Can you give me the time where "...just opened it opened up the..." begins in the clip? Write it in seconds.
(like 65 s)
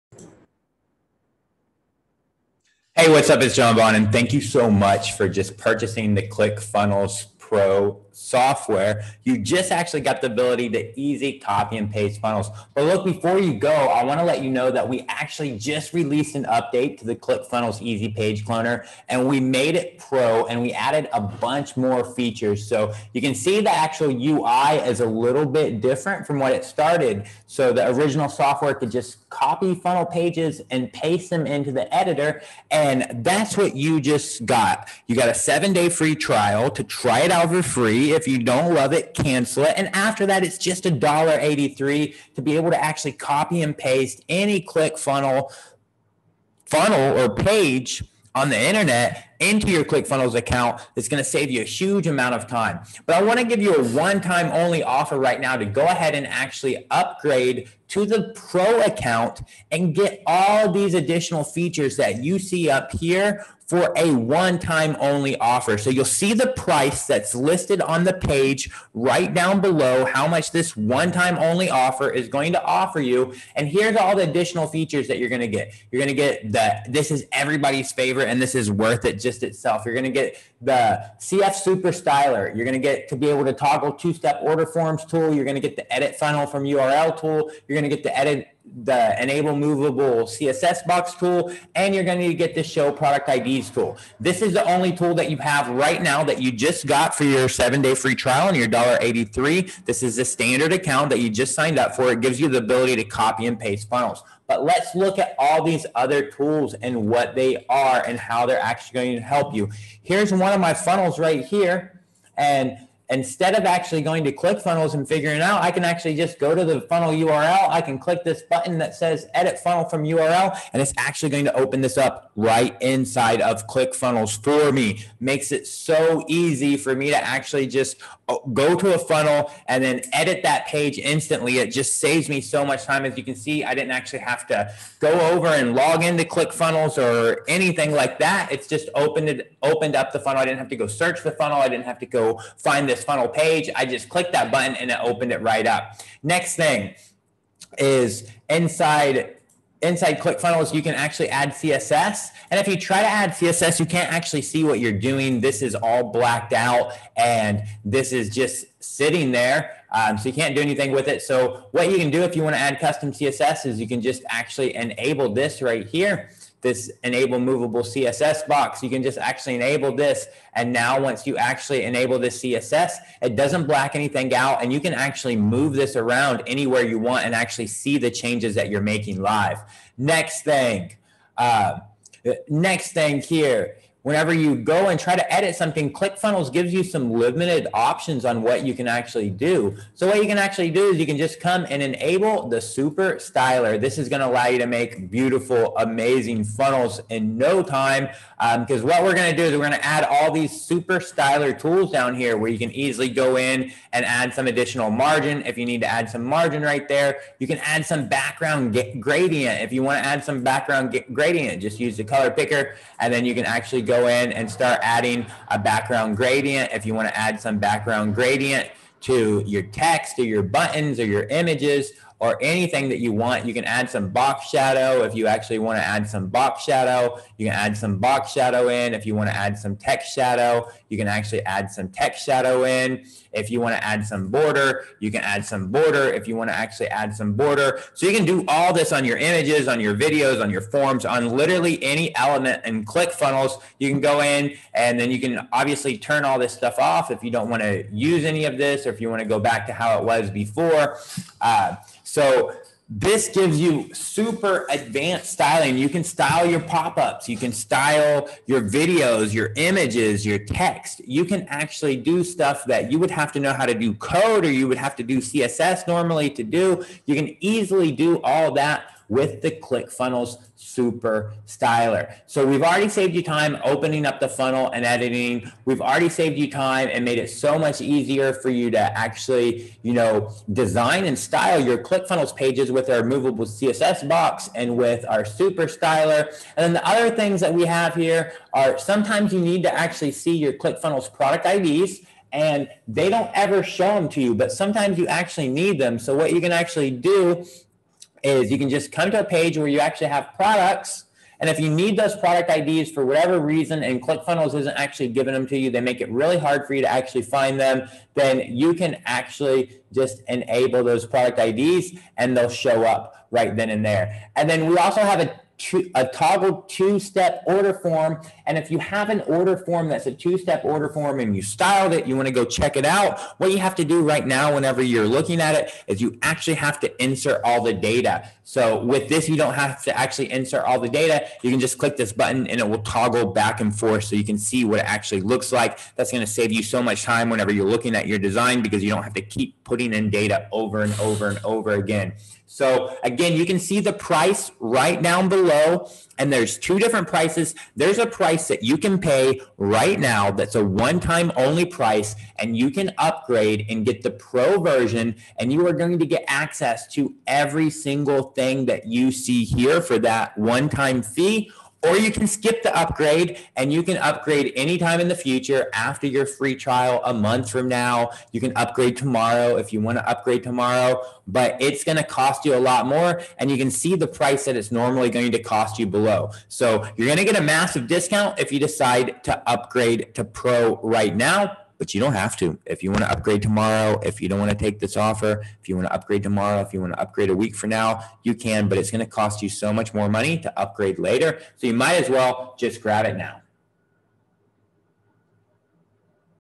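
138 s.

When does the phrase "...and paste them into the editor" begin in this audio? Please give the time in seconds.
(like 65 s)
30 s.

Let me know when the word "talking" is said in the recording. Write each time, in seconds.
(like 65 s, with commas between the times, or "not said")
not said.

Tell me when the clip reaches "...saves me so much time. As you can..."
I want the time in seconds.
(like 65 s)
131 s.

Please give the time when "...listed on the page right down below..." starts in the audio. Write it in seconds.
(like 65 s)
67 s.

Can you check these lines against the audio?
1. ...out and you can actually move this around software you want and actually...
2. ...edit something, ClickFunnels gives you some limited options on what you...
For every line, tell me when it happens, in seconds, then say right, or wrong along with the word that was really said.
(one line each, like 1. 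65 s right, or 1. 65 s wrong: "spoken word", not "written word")
1. 174 s wrong: "anywhere", not "software"
2. 185 s right.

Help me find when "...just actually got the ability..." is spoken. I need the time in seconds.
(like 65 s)
9 s.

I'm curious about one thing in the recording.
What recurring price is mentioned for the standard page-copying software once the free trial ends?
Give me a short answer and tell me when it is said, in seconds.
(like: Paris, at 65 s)
$1.83, at 40 s.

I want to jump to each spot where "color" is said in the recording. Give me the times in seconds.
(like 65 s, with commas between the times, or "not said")
212 s.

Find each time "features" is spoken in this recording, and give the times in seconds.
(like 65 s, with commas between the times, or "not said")
22 s, 61 s, 74 s.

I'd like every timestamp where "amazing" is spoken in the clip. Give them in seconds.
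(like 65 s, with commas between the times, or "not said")
195 s.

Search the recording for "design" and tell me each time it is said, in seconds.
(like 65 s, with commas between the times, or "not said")
280 s, 338 s.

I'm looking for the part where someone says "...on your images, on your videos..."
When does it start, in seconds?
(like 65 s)
238 s.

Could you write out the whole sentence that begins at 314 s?
And then we also have a two, a toggle two-step order form.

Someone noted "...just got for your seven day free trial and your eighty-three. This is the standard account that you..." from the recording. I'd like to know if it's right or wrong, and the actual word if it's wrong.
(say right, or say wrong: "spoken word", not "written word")
right.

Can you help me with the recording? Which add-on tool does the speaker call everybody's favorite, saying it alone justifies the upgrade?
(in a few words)
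CF Super Styler.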